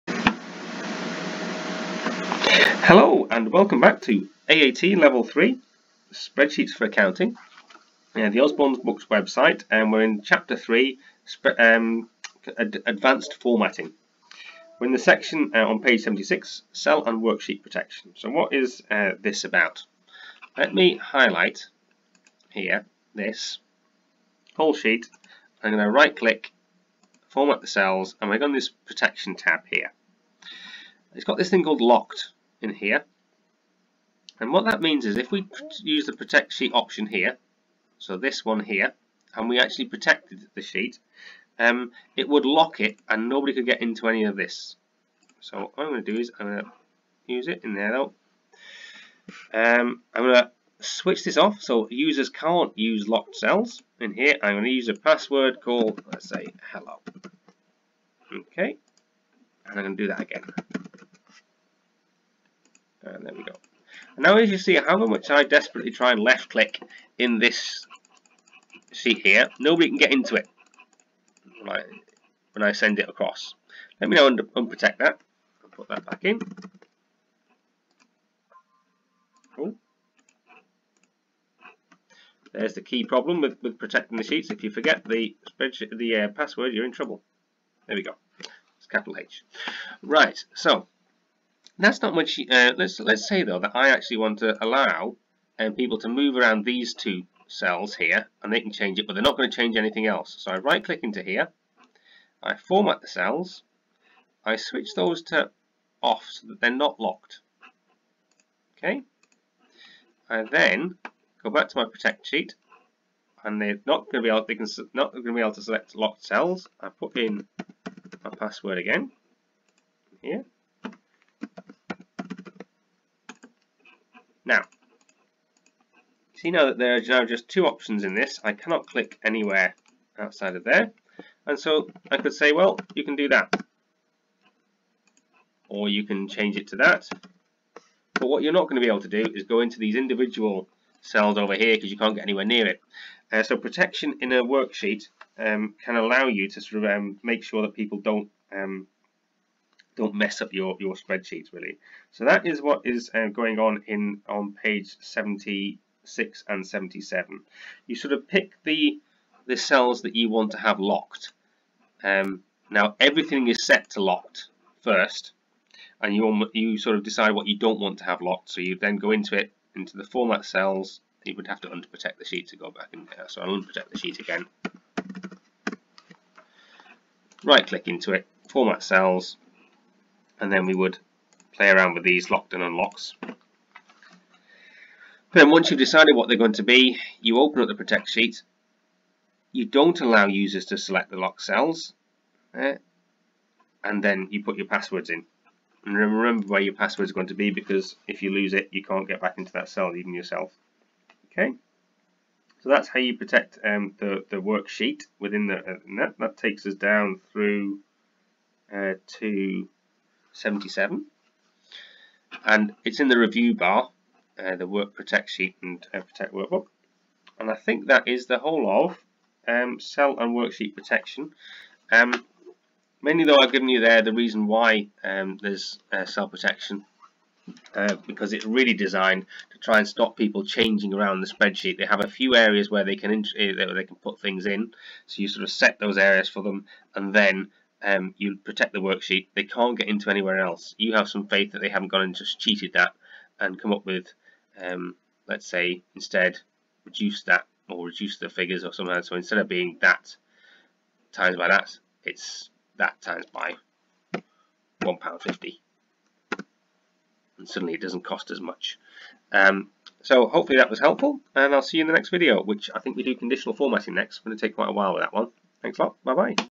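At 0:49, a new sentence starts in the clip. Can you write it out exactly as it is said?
Um, I'm going to switch this off so users can't use locked cells.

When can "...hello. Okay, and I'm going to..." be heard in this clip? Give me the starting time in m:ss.
0:56.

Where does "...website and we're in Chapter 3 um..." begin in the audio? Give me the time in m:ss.
0:09.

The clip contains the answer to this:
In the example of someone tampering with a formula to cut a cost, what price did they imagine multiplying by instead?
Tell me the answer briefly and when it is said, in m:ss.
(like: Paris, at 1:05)
£1.50, at 4:14.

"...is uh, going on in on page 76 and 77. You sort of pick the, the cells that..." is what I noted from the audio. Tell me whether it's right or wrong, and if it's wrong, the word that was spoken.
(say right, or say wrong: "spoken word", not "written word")
right.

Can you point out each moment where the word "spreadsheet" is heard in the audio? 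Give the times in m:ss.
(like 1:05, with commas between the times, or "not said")
0:06, 1:25, 2:30, 3:51.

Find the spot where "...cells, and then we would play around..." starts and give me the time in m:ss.
2:58.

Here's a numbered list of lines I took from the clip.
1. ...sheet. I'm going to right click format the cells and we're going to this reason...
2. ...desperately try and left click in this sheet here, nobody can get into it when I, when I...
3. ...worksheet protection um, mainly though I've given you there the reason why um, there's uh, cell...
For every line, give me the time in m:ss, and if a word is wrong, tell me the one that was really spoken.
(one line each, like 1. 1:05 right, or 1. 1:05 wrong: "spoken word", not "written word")
1. 0:24 wrong: "protection", not "reason"
2. 1:05 right
3. 3:40 right.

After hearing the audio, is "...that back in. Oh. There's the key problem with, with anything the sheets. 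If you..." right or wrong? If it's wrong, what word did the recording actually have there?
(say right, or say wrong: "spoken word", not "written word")
wrong: "protecting", not "anything".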